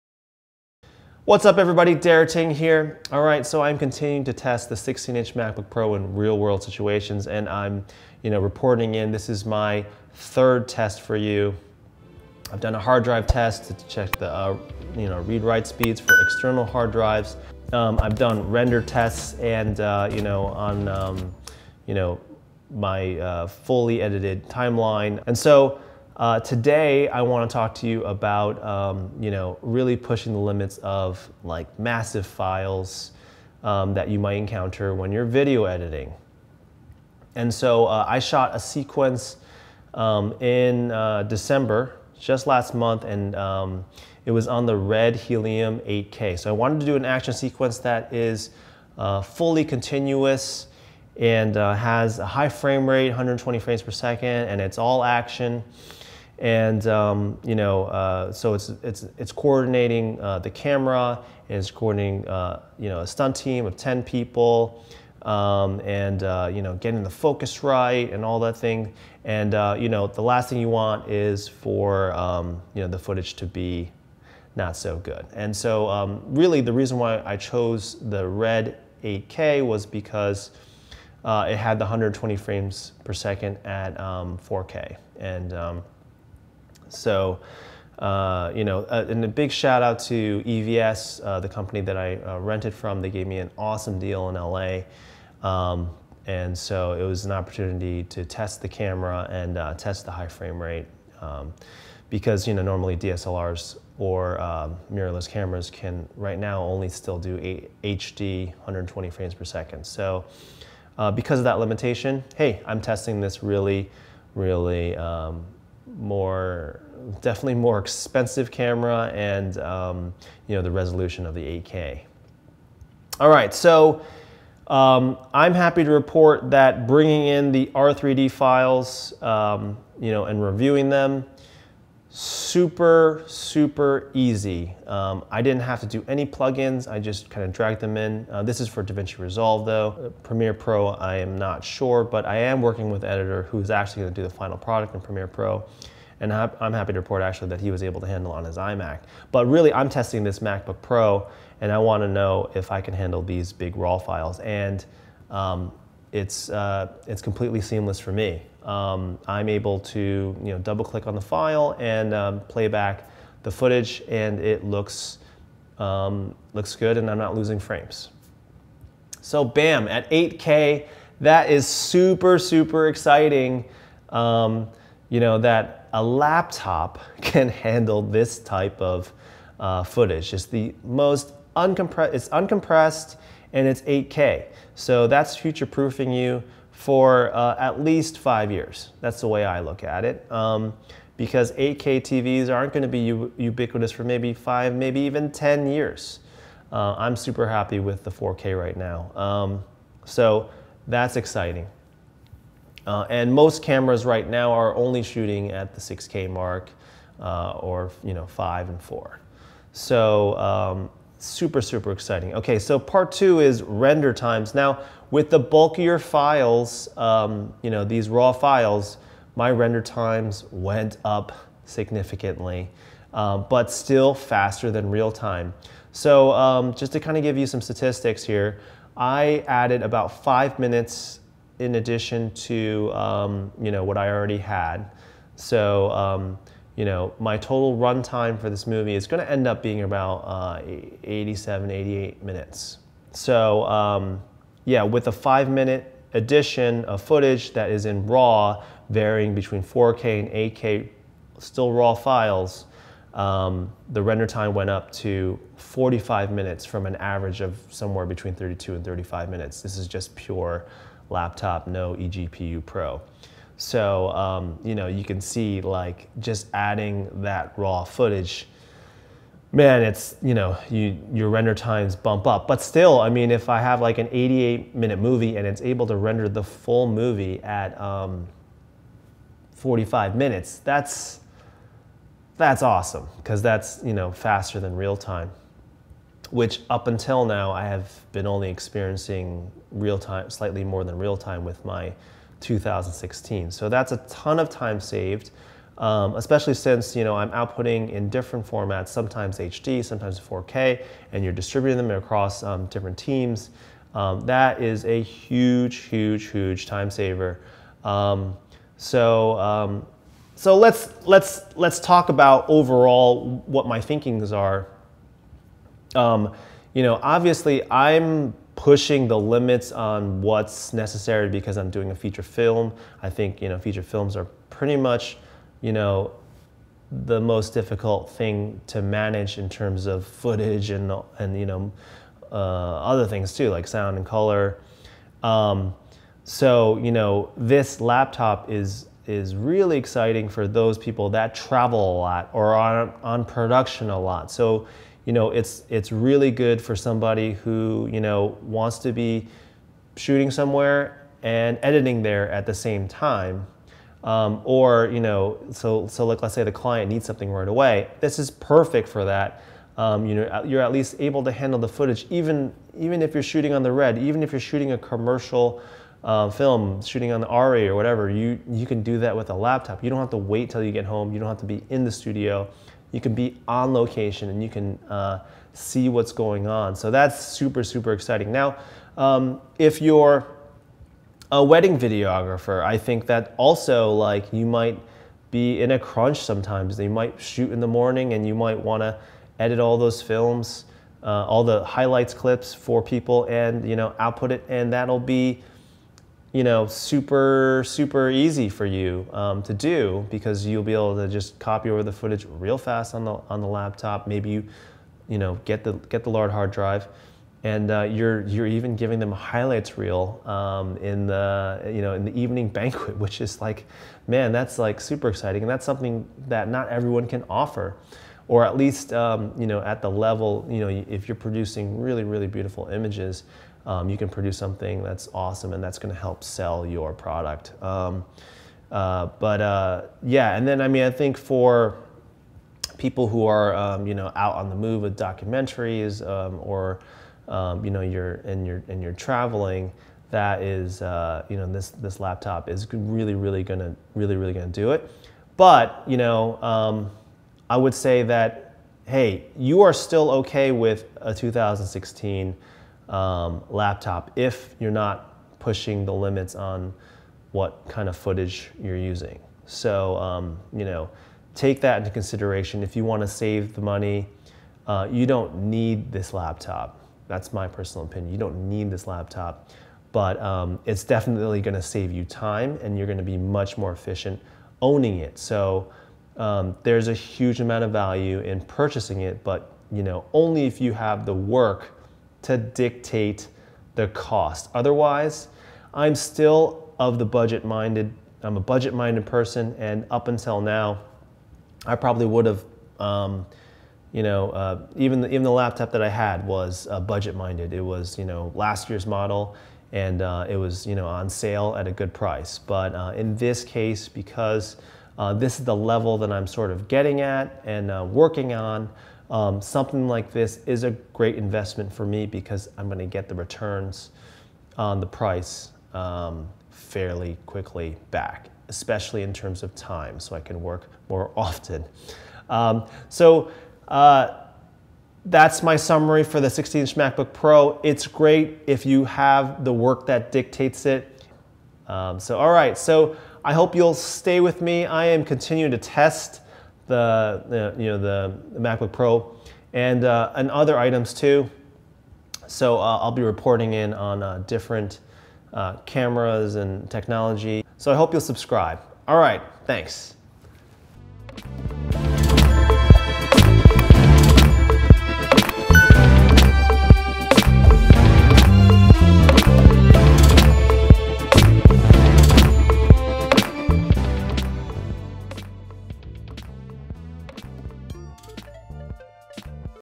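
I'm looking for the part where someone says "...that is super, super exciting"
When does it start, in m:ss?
2:51.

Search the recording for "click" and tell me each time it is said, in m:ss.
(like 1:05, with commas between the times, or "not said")
2:40.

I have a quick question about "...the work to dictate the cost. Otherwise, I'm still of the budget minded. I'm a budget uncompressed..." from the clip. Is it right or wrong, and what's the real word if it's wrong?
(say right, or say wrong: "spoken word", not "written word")
wrong: "minded", not "uncompressed".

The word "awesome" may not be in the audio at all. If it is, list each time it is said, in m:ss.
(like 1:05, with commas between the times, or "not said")
1:33, 4:42, 7:05.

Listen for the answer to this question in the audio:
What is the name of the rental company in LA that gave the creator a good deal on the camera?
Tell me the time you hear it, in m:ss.
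1:30.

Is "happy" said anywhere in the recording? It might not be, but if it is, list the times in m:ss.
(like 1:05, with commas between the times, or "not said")
2:05, 2:26, 3:17.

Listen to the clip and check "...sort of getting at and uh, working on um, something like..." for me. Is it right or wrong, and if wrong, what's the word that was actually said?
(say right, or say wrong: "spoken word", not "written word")
right.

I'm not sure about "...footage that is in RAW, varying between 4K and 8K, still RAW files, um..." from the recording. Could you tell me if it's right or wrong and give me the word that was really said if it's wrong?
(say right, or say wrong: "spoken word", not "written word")
right.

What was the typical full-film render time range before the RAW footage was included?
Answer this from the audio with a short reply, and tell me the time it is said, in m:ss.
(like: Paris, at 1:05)
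32 to 35 minutes, at 4:18.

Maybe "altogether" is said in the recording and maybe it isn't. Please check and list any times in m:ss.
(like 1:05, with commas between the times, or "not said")
not said.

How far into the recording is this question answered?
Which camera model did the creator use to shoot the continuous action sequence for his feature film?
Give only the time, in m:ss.
0:44.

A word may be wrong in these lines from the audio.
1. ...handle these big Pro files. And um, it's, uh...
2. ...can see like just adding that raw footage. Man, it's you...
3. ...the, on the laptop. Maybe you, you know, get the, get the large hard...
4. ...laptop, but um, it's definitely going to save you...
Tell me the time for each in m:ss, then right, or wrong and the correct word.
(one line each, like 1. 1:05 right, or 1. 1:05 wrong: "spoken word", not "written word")
1. 2:32 wrong: "RAW", not "Pro"
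2. 4:25 right
3. 6:43 right
4. 7:48 right.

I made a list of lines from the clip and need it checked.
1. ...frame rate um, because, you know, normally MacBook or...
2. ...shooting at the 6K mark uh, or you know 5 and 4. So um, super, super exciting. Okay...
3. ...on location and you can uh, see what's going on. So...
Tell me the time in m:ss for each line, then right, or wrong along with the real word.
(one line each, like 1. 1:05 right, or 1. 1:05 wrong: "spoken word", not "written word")
1. 1:40 wrong: "DSLRs", not "MacBook"
2. 3:25 right
3. 6:13 right.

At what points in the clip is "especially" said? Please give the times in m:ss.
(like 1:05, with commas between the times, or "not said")
4:56, 8:38.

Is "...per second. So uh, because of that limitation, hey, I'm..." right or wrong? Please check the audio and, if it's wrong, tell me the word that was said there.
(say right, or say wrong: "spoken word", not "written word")
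right.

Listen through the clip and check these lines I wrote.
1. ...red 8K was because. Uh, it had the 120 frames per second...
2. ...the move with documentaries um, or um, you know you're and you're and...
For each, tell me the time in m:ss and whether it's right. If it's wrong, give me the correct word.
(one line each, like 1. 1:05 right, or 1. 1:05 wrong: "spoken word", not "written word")
1. 1:18 right
2. 7:14 right.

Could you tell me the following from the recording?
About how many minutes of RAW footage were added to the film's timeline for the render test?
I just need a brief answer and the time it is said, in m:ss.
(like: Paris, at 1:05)
5, at 3:50.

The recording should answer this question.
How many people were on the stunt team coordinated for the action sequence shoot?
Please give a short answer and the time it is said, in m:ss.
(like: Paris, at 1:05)
10, at 1:03.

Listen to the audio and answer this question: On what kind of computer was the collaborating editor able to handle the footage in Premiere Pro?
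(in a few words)
iMac.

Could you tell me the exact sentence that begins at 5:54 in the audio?
Um, or you know, so so like let's say the client needs something right away.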